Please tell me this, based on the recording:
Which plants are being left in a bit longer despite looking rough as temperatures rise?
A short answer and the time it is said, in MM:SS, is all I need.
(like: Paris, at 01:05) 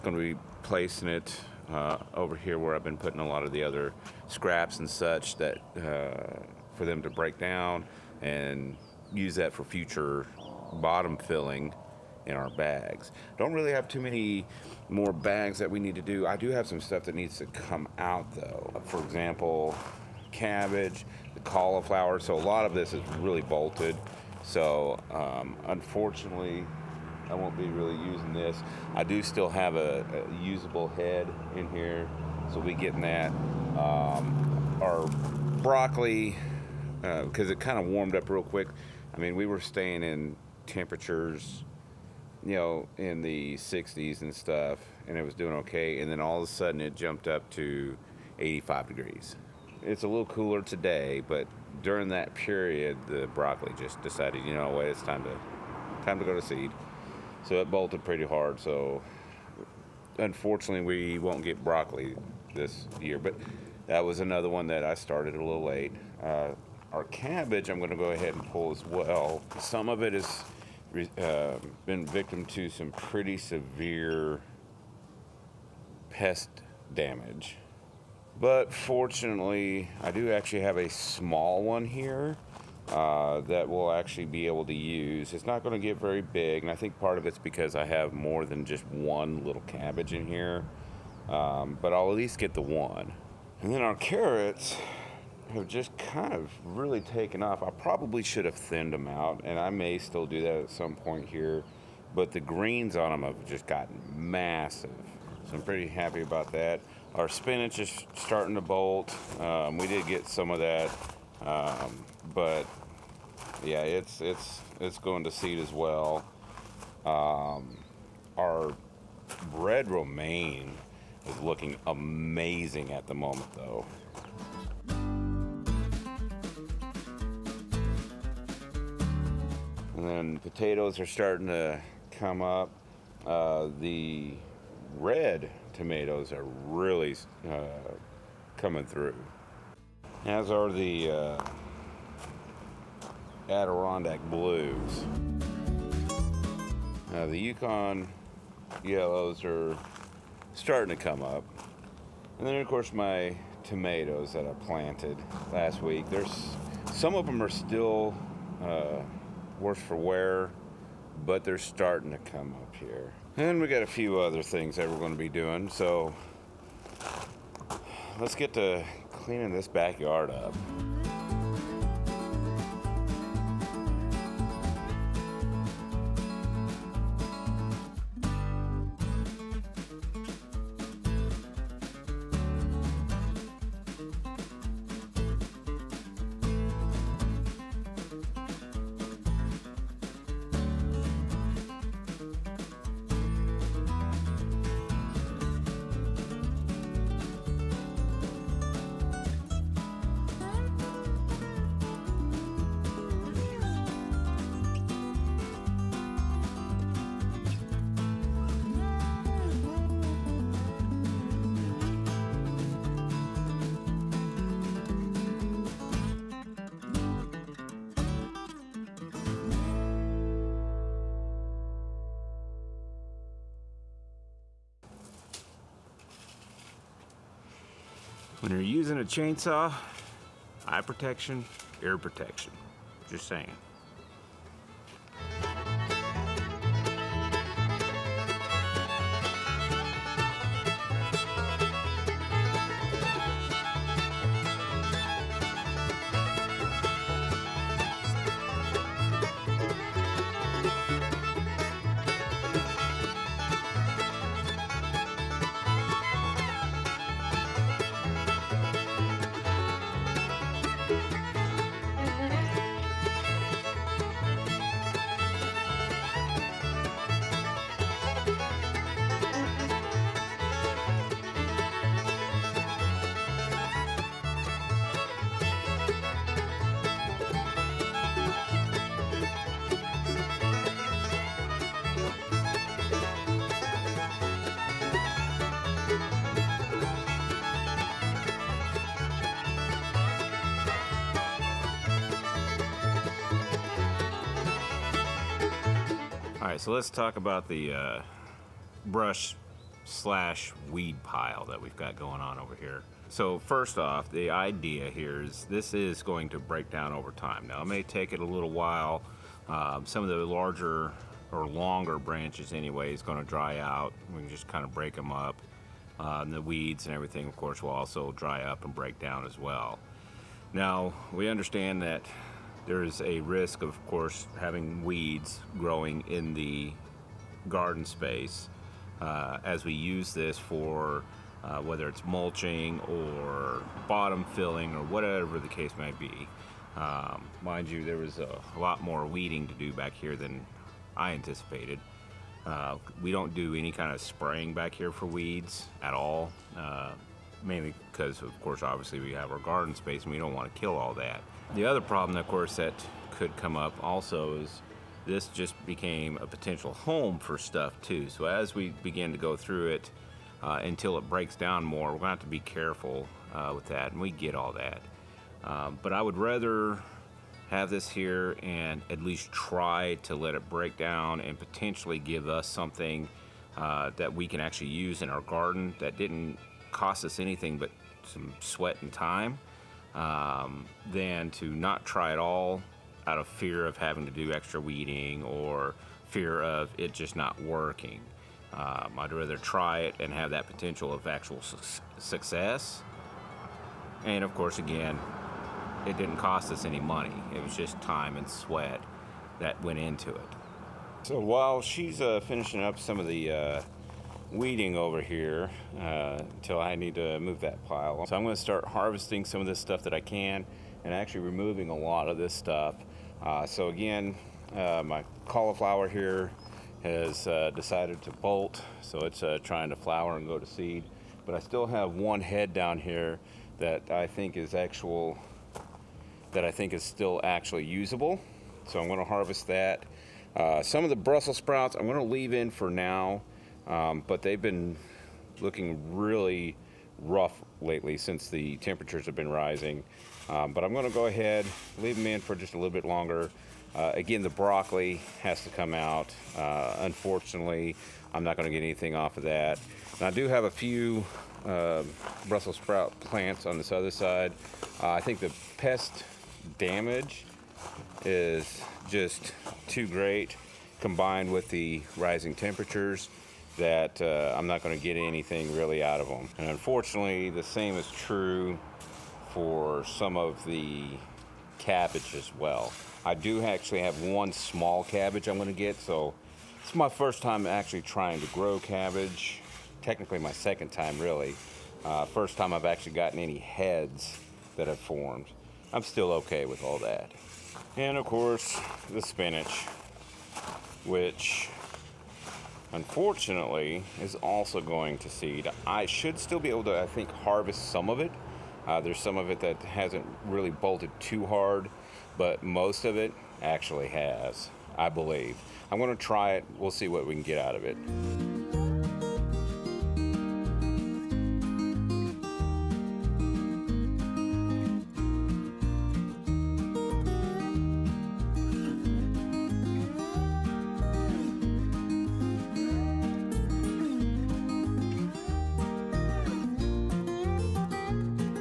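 Brussels sprouts, at 07:10.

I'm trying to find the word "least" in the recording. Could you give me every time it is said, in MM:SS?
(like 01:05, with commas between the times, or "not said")
01:32, 06:09.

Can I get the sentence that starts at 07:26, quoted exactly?
Uh, unfortunately, I'm not going to get anything off of that.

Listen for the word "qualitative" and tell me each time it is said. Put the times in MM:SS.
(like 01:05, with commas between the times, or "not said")
not said.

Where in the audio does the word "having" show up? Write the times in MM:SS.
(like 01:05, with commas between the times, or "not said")
05:24, 06:23.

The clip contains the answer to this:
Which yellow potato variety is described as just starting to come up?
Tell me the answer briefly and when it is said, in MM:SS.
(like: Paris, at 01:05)
Yukon yellows, at 02:27.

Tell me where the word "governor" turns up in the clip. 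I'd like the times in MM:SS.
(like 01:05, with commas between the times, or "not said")
not said.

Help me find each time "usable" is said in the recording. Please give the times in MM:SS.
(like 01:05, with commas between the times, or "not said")
00:30, 07:07.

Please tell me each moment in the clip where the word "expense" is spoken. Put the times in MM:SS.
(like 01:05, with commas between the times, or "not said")
not said.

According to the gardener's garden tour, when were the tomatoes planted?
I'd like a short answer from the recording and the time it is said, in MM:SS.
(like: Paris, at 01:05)
last week, at 02:35.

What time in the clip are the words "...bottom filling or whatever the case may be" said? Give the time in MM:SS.
05:33.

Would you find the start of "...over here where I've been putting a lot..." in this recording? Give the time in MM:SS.
00:02.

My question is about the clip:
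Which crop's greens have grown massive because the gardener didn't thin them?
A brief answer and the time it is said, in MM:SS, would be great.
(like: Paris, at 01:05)
carrots, at 01:33.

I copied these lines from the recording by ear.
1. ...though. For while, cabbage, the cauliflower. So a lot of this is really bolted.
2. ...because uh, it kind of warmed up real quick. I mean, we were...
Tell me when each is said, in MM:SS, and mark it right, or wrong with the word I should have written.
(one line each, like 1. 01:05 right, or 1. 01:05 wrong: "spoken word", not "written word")
1. 00:18 wrong: "example", not "while"
2. 00:37 right.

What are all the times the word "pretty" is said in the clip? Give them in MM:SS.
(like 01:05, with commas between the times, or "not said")
00:58, 01:12, 01:45.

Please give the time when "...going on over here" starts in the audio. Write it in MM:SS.
05:01.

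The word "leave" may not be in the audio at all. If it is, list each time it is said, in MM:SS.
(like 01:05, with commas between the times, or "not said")
07:12, 07:21.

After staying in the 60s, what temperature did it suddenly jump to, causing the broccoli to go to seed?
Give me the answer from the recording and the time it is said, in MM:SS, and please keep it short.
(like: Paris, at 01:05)
85 degrees, at 00:48.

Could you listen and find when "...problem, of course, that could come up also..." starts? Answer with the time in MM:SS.
05:51.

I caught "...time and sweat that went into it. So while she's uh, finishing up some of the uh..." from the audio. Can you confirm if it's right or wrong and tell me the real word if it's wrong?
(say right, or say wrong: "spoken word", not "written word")
right.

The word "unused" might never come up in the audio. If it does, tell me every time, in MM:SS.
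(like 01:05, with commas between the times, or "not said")
not said.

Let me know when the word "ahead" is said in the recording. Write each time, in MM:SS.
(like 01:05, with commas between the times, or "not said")
01:08, 07:21.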